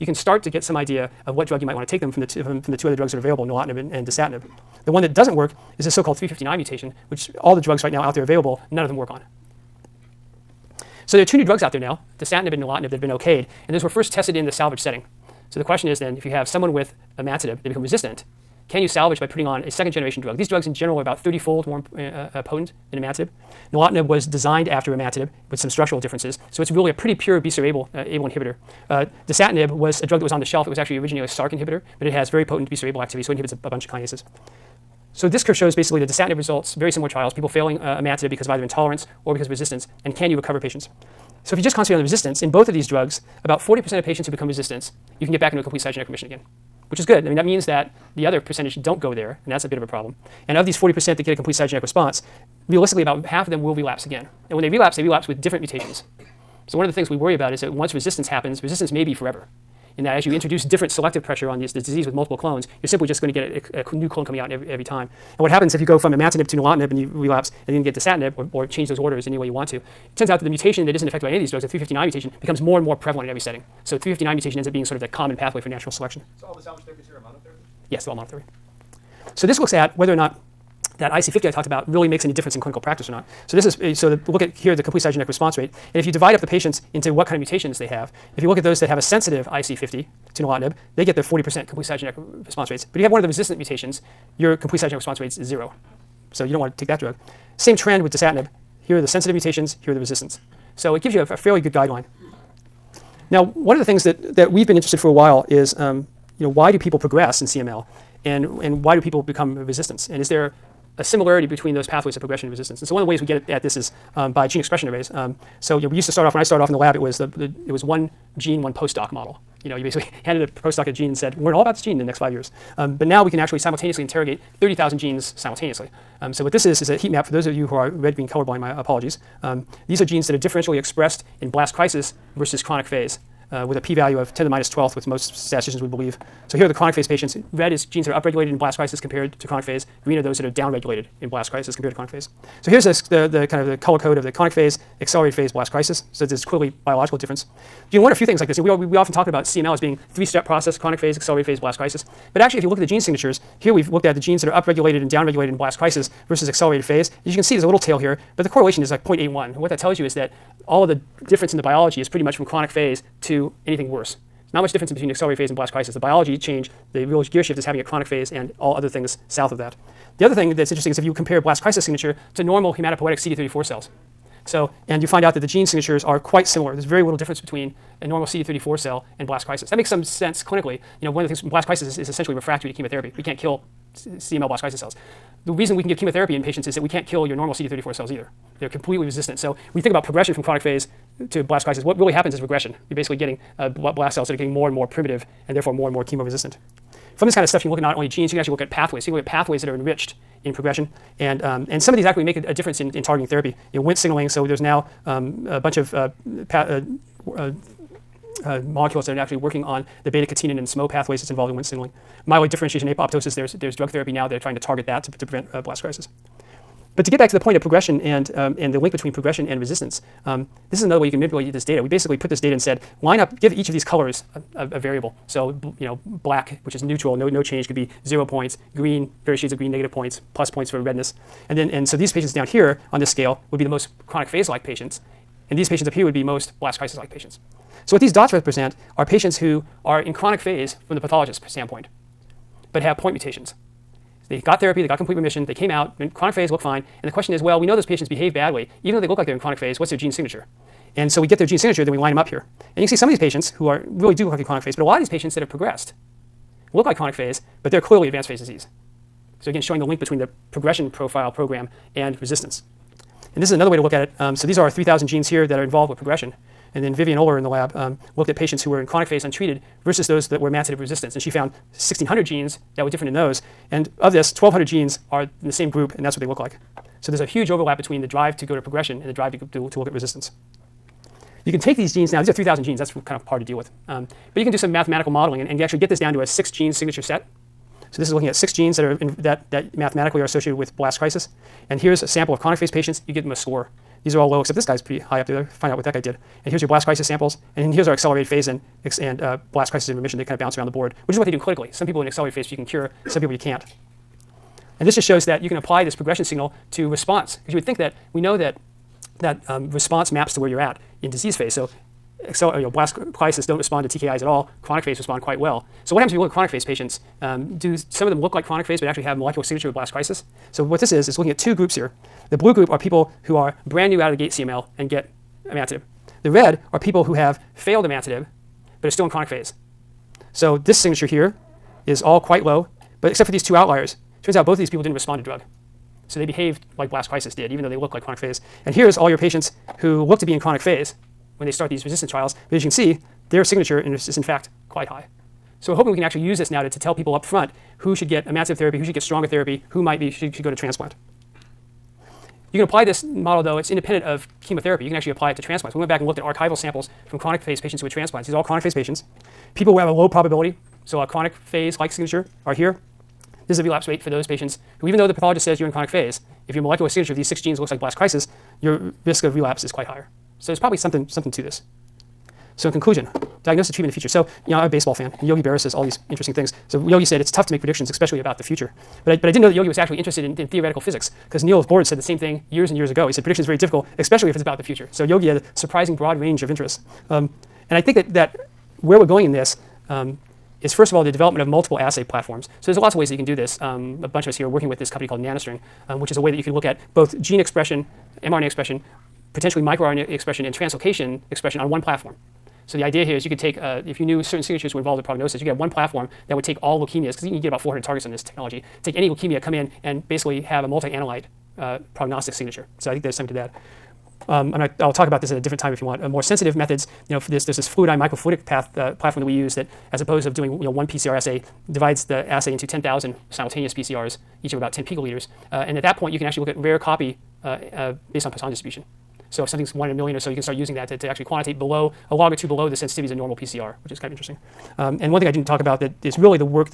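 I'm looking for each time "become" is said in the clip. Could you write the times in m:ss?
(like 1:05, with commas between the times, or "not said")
0:17, 0:44, 1:12, 1:49.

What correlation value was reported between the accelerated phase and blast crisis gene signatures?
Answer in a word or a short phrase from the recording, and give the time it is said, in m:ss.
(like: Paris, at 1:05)
0.81, at 2:39.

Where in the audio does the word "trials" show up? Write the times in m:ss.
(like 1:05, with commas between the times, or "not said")
0:37, 5:42.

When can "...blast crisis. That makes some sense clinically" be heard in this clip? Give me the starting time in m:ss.
2:59.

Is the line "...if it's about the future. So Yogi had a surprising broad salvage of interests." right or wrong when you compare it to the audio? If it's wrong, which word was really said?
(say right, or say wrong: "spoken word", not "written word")
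wrong: "range", not "salvage".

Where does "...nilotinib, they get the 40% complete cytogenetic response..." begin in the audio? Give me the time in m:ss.
1:30.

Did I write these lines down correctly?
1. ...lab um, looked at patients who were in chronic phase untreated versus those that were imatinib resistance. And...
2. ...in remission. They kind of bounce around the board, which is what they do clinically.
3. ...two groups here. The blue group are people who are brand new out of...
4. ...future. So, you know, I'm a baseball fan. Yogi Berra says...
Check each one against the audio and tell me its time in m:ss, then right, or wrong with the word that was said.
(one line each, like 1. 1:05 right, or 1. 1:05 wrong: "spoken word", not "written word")
1. 4:27 right
2. 4:59 right
3. 5:21 right
4. 6:13 right.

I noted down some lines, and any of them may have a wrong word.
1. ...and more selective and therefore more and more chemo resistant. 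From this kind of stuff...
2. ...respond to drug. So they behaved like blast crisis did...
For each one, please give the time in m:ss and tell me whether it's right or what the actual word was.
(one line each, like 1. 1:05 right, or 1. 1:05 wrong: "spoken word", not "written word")
1. 3:14 wrong: "primitive", not "selective"
2. 5:34 right.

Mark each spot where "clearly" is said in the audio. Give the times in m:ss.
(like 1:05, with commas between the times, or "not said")
2:26, 4:17.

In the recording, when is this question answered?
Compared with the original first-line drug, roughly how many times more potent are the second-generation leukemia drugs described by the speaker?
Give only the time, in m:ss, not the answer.
0:21.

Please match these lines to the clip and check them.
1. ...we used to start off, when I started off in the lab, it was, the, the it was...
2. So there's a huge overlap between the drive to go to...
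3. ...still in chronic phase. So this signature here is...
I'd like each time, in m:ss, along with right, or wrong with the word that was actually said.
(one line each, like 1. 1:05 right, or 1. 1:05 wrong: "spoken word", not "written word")
1. 1:55 right
2. 4:36 right
3. 5:28 right.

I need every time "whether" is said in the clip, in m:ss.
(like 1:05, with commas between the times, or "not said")
1:19.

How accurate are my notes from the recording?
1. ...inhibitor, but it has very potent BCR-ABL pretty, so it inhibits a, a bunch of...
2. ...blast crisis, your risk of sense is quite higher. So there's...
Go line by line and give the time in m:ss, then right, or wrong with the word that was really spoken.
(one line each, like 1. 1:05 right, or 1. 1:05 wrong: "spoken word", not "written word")
1. 0:31 wrong: "activity", not "pretty"
2. 6:07 wrong: "relapse", not "sense".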